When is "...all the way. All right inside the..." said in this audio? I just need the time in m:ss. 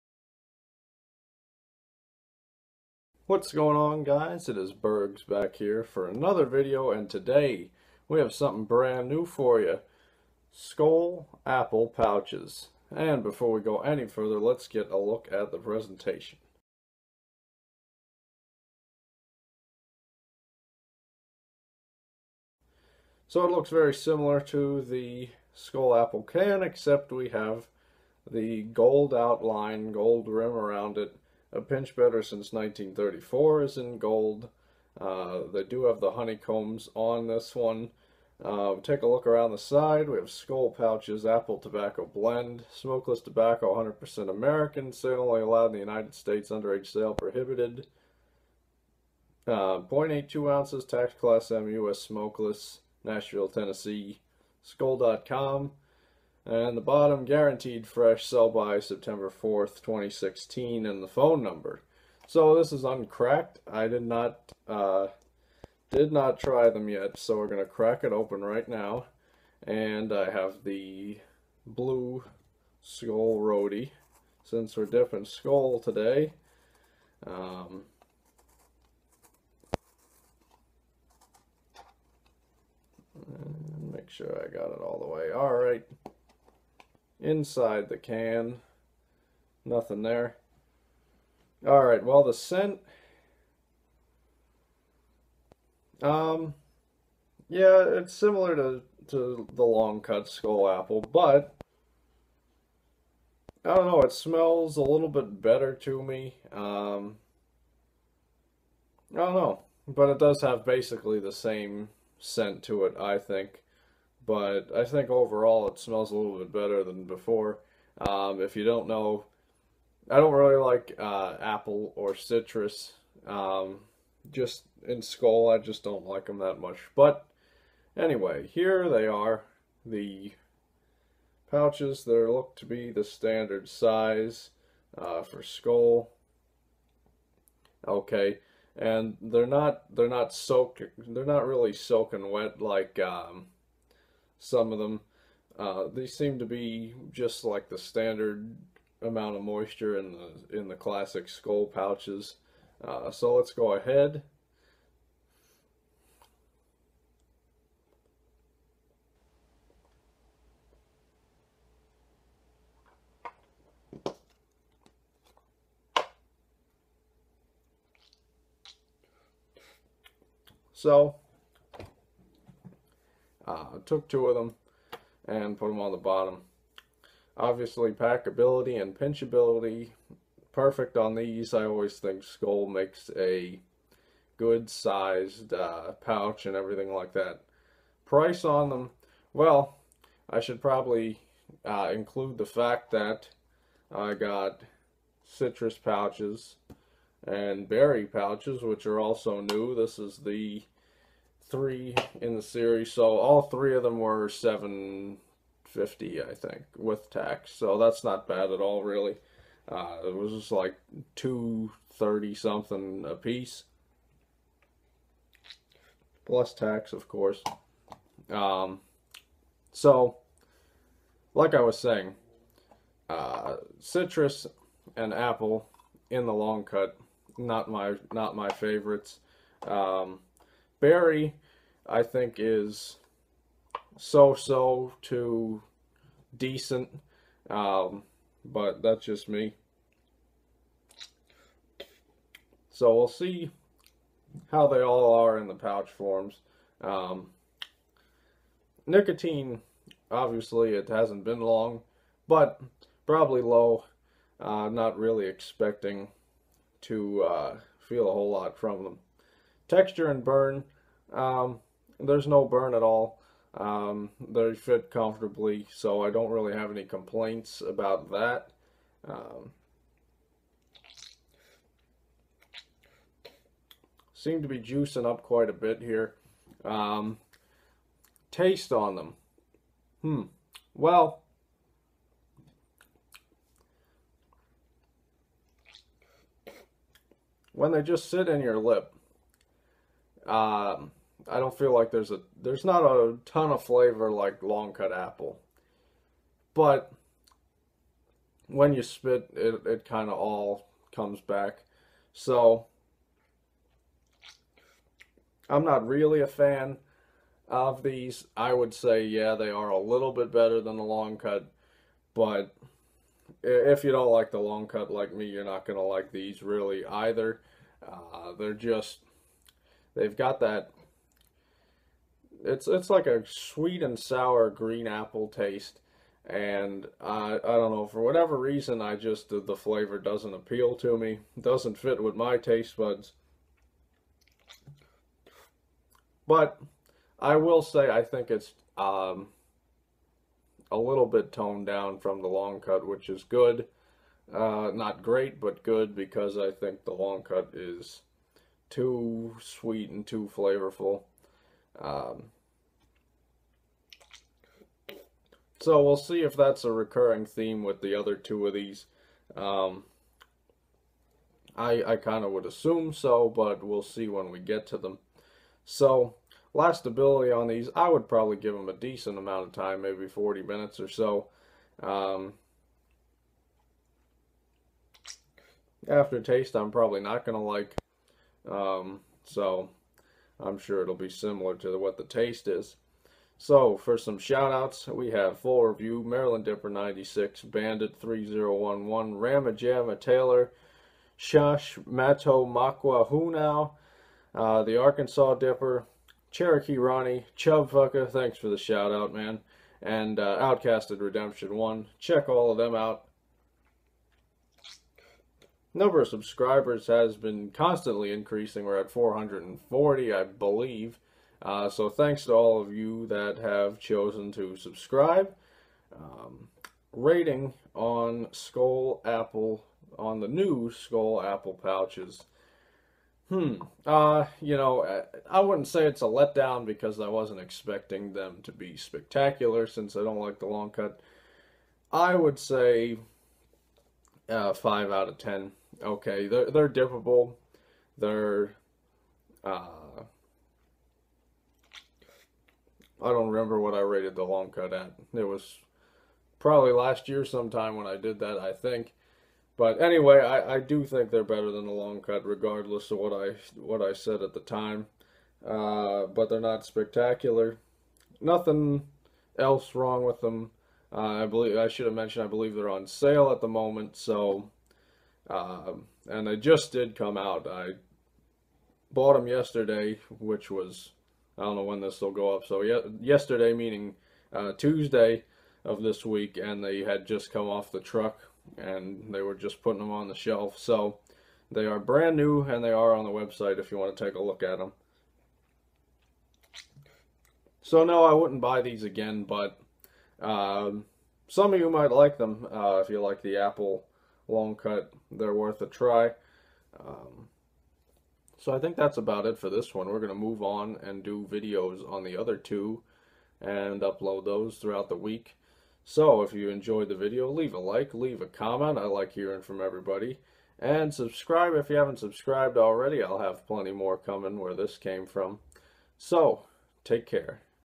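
1:24.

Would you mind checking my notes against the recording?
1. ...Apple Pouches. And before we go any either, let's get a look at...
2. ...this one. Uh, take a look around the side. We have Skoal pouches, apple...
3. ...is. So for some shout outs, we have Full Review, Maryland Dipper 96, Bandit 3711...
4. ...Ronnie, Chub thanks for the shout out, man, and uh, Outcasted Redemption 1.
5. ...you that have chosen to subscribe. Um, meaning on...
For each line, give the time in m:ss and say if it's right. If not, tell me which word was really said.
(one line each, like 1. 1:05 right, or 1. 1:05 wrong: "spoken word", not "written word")
1. 0:11 wrong: "further", not "either"
2. 0:37 right
3. 6:22 wrong: "3011", not "3711"
4. 6:36 right
5. 6:52 wrong: "rating", not "meaning".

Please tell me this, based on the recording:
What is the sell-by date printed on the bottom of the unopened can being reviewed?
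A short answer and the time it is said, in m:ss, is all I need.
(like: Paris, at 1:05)
September 4th, 2016, at 0:58.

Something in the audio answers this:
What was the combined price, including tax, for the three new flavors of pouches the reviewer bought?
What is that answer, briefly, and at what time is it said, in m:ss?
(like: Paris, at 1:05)
7.50, at 3:24.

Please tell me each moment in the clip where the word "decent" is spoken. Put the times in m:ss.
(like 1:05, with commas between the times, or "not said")
3:56, 6:08.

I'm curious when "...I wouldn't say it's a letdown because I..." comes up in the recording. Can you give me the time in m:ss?
7:05.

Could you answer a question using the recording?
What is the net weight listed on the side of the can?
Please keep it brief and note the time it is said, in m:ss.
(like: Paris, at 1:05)
0.82 ounces, at 0:49.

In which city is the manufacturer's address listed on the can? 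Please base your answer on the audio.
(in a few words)
Nashville, Tennessee.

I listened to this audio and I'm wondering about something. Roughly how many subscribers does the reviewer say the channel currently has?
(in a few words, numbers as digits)
440.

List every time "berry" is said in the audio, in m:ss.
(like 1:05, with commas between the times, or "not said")
3:17, 3:50.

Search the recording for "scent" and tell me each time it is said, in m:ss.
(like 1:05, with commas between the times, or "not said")
1:32, 1:52.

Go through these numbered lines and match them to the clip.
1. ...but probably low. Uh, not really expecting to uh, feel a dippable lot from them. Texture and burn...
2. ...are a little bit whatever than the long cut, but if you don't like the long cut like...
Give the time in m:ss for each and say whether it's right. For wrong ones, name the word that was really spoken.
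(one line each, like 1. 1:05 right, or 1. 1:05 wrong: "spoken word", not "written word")
1. 4:12 wrong: "whole", not "dippable"
2. 5:09 wrong: "better", not "whatever".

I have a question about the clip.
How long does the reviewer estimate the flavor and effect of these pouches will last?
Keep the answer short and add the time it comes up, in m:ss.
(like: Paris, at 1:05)
40 minutes, at 6:10.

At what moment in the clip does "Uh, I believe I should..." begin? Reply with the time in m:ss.
7:40.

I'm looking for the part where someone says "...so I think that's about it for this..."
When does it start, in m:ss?
8:18.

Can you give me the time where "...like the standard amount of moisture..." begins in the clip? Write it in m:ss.
2:27.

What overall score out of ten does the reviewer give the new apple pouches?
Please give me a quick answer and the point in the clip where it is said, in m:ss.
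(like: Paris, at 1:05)
5, at 7:14.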